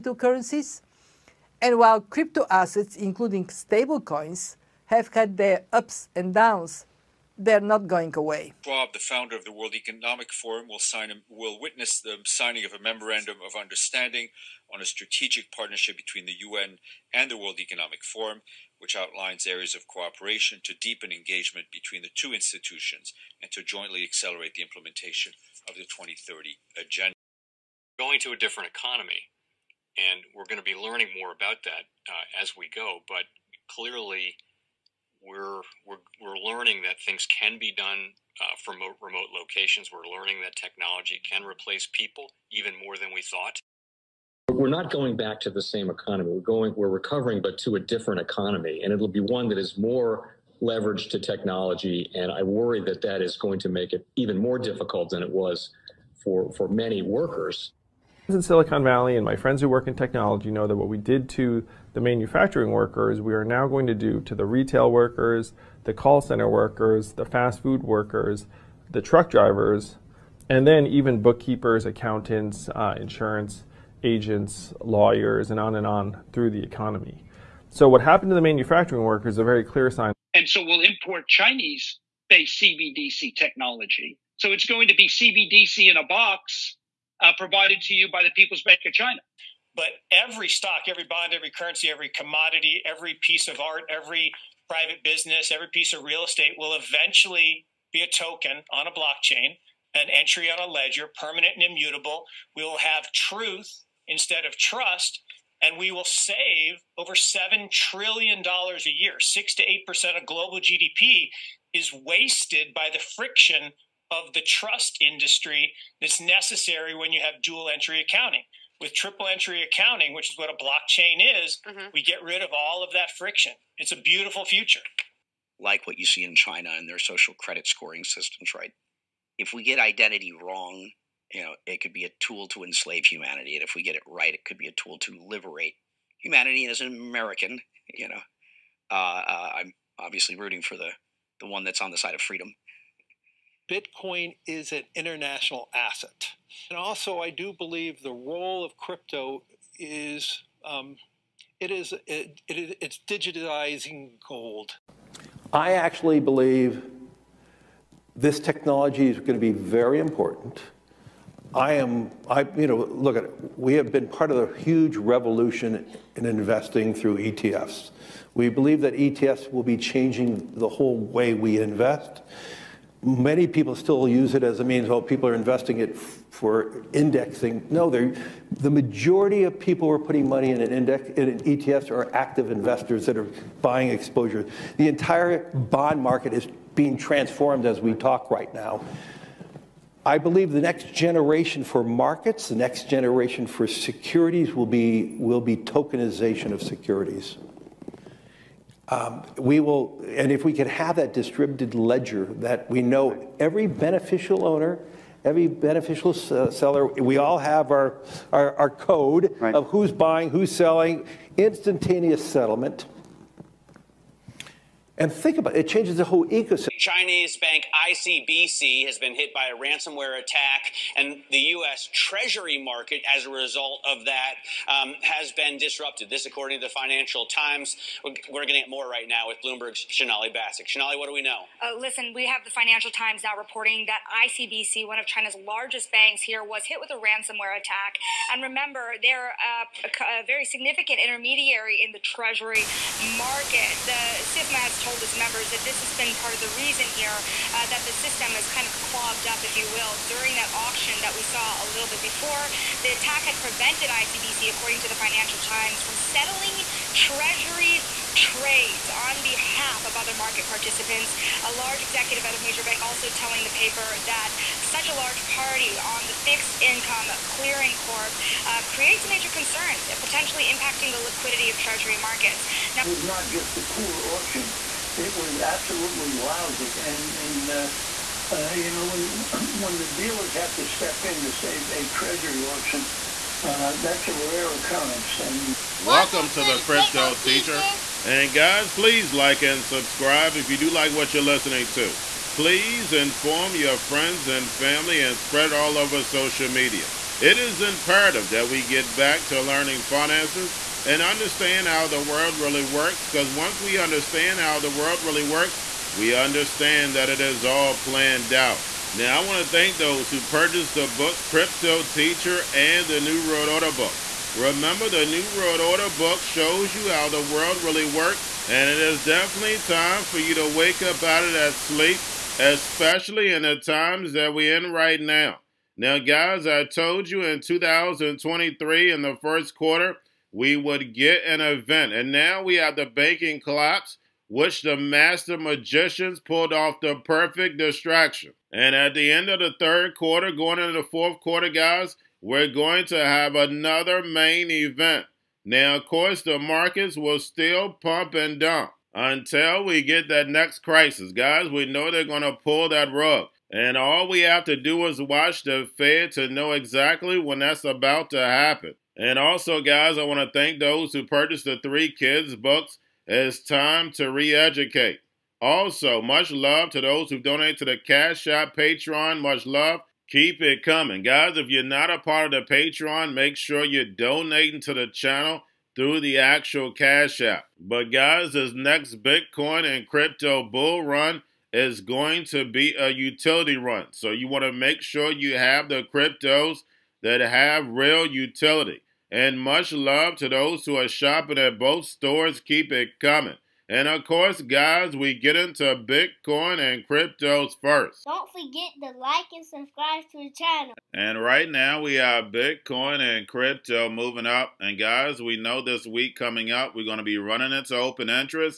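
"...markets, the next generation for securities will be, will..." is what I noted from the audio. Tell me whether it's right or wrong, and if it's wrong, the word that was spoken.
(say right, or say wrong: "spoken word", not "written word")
right.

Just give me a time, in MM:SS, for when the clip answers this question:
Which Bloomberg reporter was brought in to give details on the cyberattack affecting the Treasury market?
03:49.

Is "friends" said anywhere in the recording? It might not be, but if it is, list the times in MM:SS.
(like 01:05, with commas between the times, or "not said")
00:59, 04:53.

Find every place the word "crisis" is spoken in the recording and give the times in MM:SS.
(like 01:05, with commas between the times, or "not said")
05:50.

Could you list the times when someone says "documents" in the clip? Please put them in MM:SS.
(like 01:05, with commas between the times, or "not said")
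not said.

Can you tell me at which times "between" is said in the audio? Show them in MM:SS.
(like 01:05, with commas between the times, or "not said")
00:15, 00:21.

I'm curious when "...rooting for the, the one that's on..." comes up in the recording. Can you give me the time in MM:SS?
02:20.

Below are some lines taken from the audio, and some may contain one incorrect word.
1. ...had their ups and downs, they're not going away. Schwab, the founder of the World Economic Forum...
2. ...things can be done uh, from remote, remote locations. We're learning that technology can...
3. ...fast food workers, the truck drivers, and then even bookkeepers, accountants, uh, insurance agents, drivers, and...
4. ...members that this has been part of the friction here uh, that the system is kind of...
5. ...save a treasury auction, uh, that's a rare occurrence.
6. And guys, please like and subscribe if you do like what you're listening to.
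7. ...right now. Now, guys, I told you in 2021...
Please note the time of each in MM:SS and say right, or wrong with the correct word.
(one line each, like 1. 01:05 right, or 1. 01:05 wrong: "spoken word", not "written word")
1. 00:05 right
2. 00:37 right
3. 01:07 wrong: "lawyers", not "drivers"
4. 04:05 wrong: "reason", not "friction"
5. 04:41 right
6. 04:48 right
7. 05:24 wrong: "2023", not "2021".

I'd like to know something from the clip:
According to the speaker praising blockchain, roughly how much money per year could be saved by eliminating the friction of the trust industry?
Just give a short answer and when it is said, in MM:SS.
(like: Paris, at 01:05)
Over $7 trillion, at 01:46.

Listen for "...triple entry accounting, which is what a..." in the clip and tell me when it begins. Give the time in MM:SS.
01:58.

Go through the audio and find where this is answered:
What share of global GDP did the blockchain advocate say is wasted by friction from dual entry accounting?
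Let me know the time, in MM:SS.
01:49.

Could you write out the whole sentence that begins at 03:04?
The entire bond market is being transformed as we talk right now.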